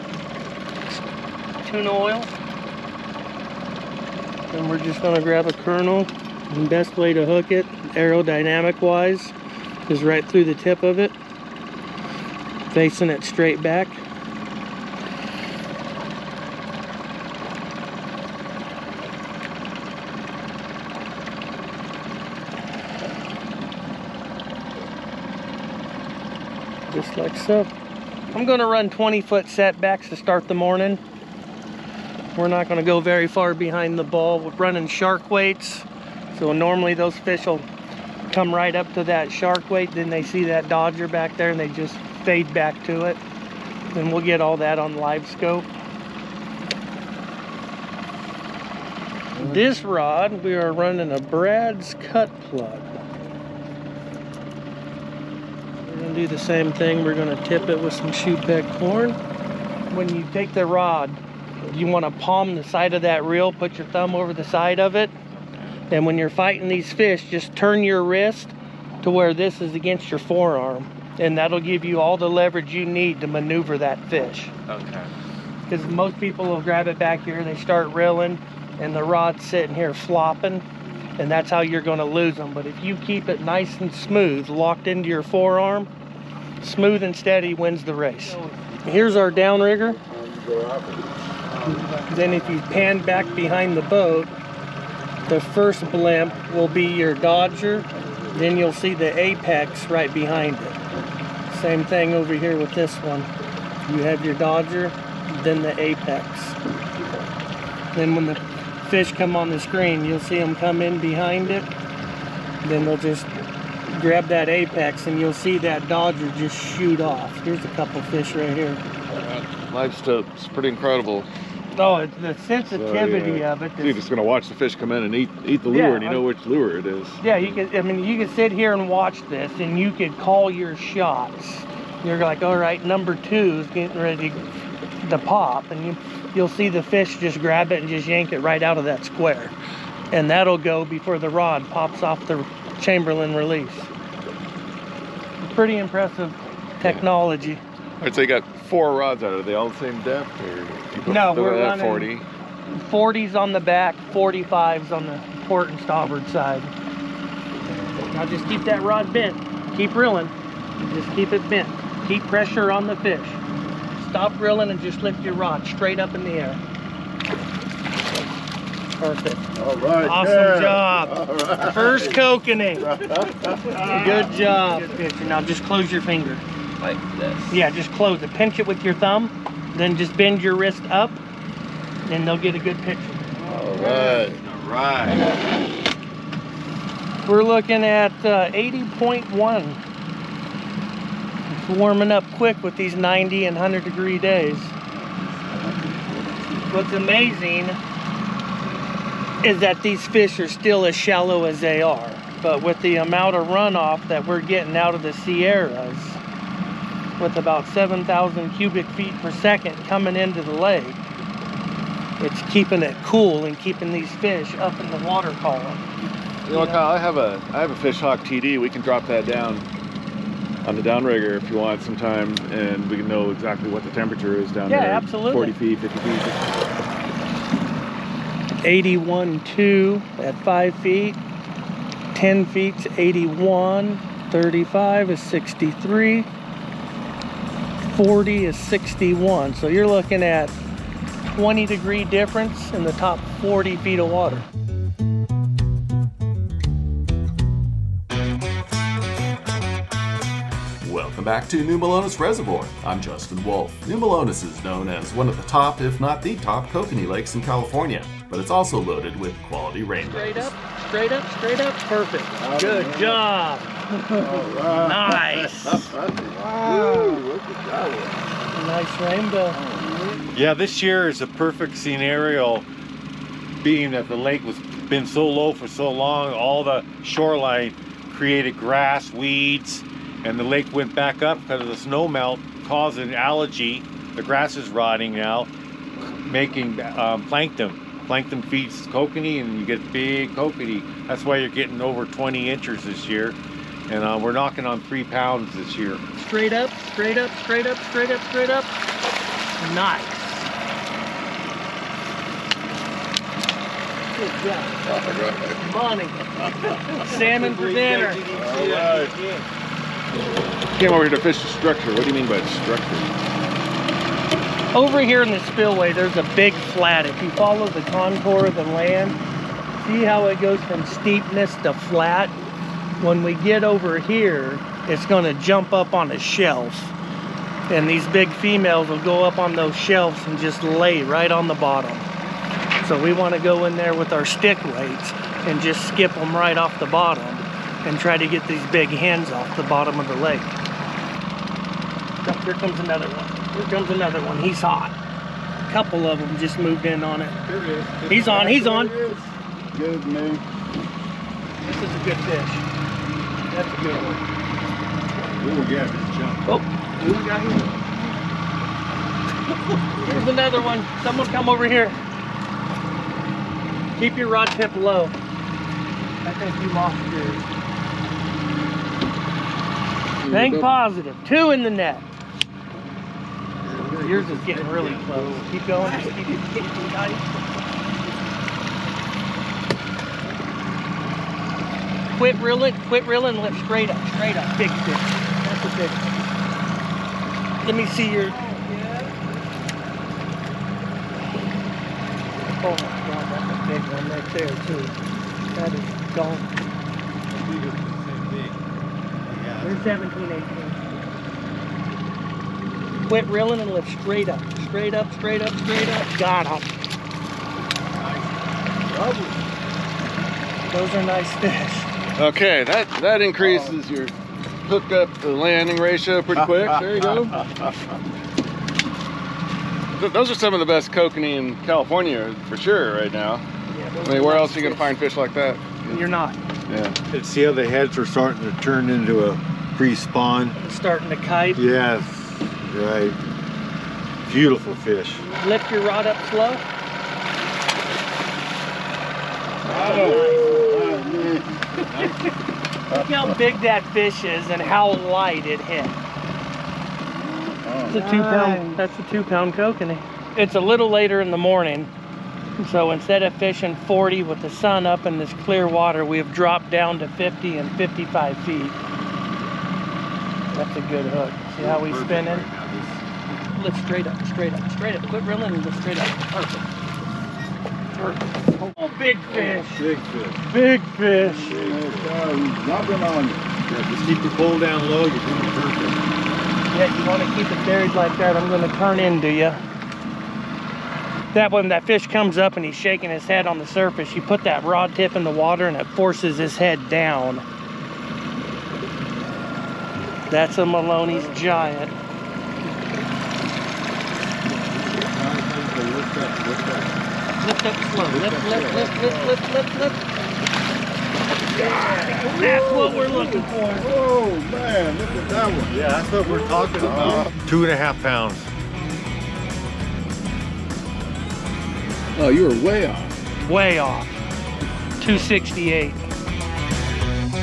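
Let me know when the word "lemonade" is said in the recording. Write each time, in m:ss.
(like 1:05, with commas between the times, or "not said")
not said.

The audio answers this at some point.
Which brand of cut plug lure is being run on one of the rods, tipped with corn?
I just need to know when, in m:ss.
0:51.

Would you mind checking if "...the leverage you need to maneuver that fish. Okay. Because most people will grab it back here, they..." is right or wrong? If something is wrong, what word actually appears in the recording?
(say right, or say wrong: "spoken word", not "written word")
right.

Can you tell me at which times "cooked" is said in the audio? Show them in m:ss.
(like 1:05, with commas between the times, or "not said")
not said.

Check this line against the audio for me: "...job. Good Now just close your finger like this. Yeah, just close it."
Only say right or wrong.
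right.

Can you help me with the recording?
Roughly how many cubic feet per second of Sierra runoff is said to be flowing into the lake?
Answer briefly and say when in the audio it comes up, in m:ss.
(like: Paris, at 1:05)
7,000, at 3:27.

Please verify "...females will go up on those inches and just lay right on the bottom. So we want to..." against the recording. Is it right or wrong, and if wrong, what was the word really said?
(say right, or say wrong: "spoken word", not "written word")
wrong: "shelves", not "inches".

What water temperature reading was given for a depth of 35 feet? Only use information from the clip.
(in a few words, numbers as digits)
63.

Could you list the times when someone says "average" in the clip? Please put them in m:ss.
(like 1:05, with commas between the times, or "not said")
not said.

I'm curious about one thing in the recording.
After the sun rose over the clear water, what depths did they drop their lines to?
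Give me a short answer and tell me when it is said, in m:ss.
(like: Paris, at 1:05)
50 and 55 feet, at 7:37.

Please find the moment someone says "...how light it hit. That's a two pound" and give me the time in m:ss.
7:24.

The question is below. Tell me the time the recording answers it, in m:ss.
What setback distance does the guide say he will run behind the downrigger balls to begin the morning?
0:28.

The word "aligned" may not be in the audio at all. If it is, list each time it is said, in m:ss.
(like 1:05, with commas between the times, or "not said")
not said.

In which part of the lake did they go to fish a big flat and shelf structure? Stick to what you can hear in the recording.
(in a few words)
The spillway.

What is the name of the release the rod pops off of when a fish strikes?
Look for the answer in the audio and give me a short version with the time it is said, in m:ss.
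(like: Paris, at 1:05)
Chamberlain release, at 2:22.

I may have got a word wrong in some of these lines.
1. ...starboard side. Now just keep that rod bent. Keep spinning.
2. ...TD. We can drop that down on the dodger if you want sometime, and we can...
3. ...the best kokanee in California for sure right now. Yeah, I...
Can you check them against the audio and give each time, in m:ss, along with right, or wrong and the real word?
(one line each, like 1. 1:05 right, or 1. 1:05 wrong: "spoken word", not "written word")
1. 2:35 wrong: "reeling", not "spinning"
2. 3:38 wrong: "downrigger", not "dodger"
3. 7:00 right.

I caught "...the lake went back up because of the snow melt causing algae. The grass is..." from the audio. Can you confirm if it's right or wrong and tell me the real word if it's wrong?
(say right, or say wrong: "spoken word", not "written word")
right.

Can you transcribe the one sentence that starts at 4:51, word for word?
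That's why you're getting over 20 inches this year, and uh, we're knocking on three pounds this year.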